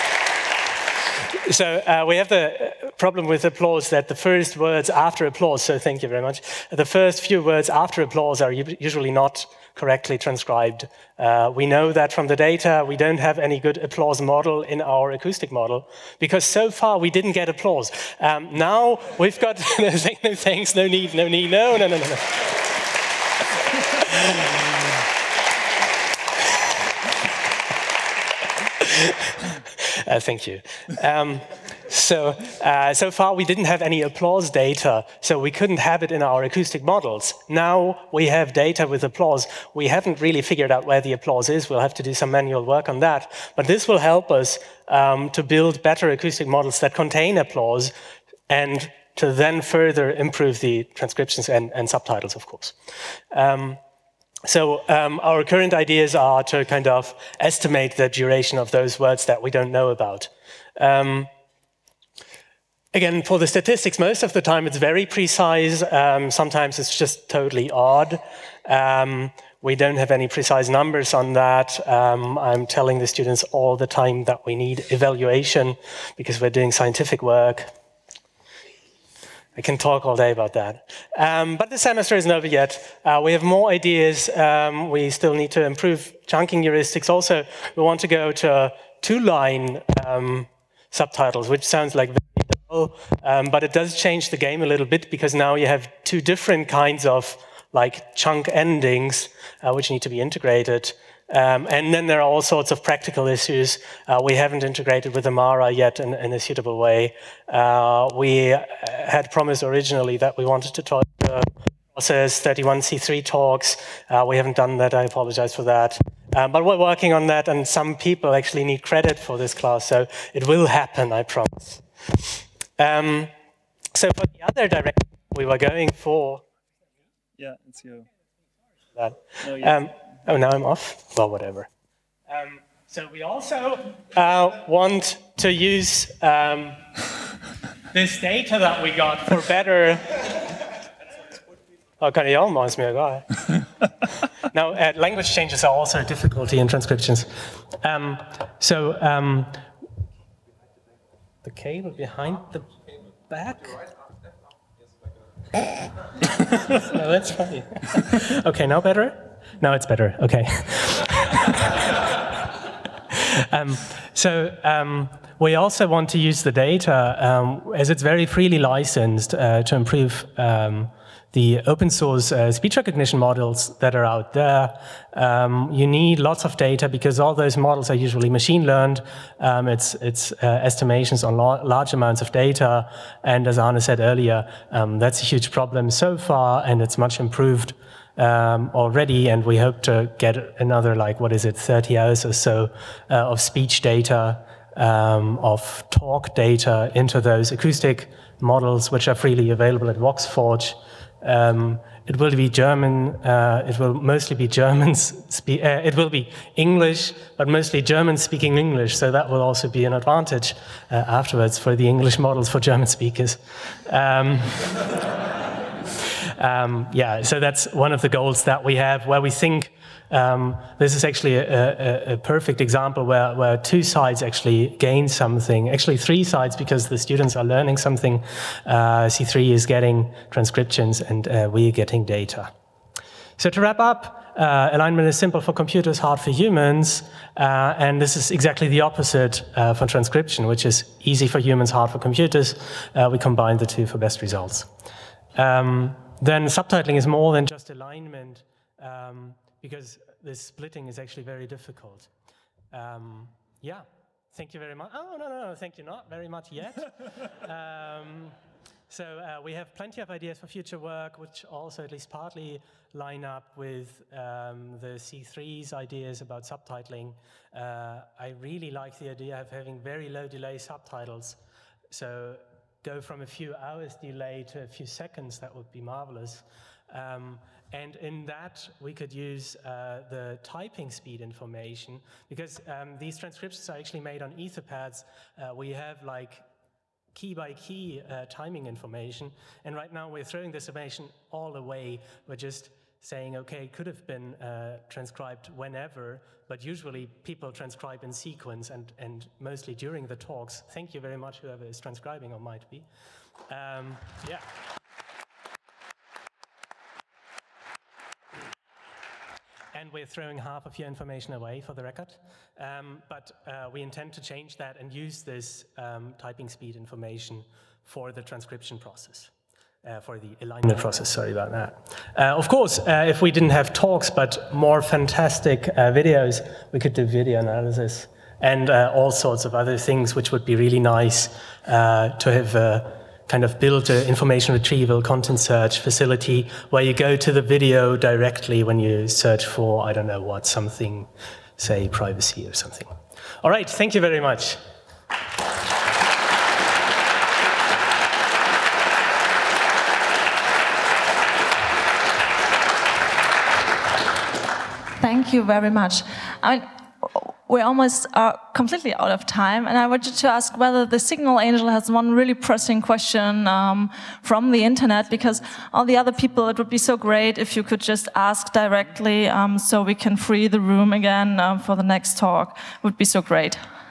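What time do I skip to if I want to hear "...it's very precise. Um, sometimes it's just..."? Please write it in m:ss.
1:04.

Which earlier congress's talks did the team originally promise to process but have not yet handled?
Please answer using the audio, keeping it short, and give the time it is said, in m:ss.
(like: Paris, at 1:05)
31C3, at 1:52.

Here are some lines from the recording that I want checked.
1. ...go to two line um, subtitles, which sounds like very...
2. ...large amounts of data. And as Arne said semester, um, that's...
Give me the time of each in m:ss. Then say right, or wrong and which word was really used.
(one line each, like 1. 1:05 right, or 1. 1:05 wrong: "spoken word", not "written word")
1. 1:28 right
2. 3:01 wrong: "earlier", not "semester".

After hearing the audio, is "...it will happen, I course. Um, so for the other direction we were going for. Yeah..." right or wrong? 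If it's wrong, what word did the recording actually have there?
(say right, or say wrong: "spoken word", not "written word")
wrong: "promise", not "course".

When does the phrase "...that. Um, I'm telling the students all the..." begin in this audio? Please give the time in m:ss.
1:11.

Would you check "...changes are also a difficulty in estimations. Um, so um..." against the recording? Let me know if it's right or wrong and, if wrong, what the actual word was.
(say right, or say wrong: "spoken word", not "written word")
wrong: "transcriptions", not "estimations".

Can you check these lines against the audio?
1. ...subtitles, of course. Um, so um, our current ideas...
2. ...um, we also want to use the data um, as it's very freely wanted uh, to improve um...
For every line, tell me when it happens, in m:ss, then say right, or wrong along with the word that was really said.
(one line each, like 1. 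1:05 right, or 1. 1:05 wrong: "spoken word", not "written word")
1. 0:51 right
2. 2:44 wrong: "licensed", not "wanted".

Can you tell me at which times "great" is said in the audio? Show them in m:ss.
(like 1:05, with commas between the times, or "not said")
6:06, 6:13.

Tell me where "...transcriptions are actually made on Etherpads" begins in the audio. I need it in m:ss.
4:43.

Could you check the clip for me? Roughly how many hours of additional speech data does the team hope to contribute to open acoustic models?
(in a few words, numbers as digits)
30 hours.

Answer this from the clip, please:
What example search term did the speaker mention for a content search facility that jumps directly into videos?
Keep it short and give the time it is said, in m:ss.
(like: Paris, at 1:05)
privacy, at 5:41.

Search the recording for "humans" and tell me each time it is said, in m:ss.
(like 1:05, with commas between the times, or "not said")
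3:56, 4:01.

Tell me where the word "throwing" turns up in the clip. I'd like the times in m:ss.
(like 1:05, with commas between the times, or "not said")
4:50, 5:10.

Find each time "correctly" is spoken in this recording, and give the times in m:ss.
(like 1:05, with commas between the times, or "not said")
0:09.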